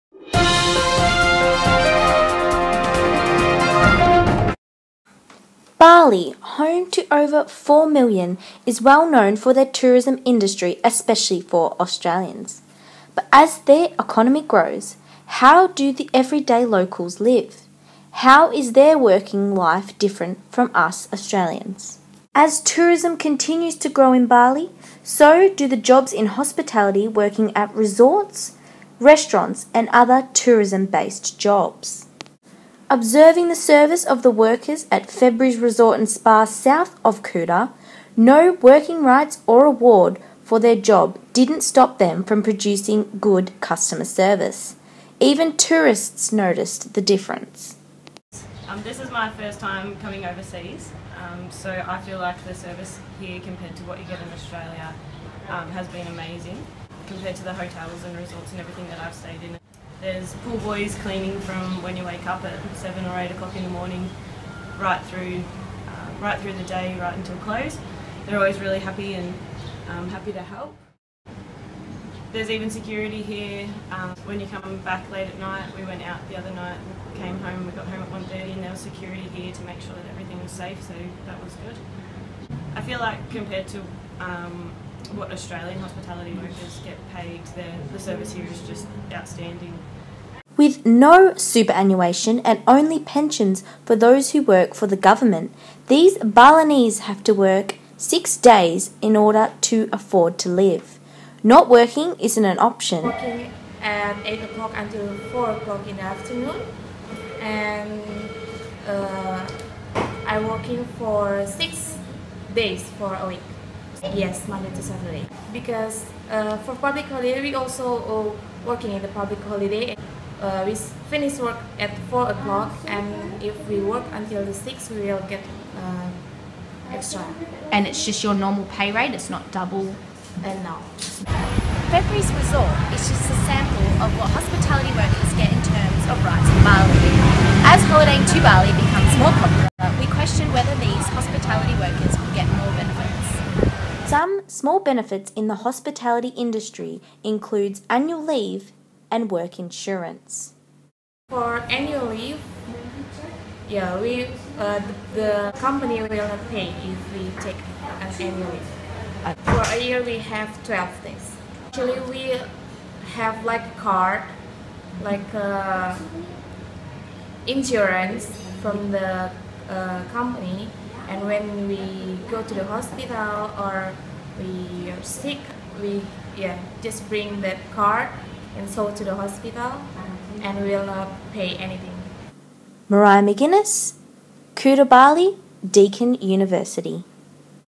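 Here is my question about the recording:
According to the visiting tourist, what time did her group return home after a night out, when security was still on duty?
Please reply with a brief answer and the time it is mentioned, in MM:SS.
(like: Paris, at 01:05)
1:30, at 01:18.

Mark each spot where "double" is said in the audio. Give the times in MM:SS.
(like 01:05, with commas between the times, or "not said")
02:09.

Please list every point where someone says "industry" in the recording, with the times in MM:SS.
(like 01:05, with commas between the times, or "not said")
00:10, 02:26.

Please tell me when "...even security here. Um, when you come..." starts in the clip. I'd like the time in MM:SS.
01:12.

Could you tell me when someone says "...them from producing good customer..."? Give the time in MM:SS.
00:41.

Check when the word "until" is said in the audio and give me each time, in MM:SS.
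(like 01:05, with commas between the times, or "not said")
01:07, 01:44, 02:04.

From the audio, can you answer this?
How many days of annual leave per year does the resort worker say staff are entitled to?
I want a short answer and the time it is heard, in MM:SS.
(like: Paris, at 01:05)
12 days, at 02:40.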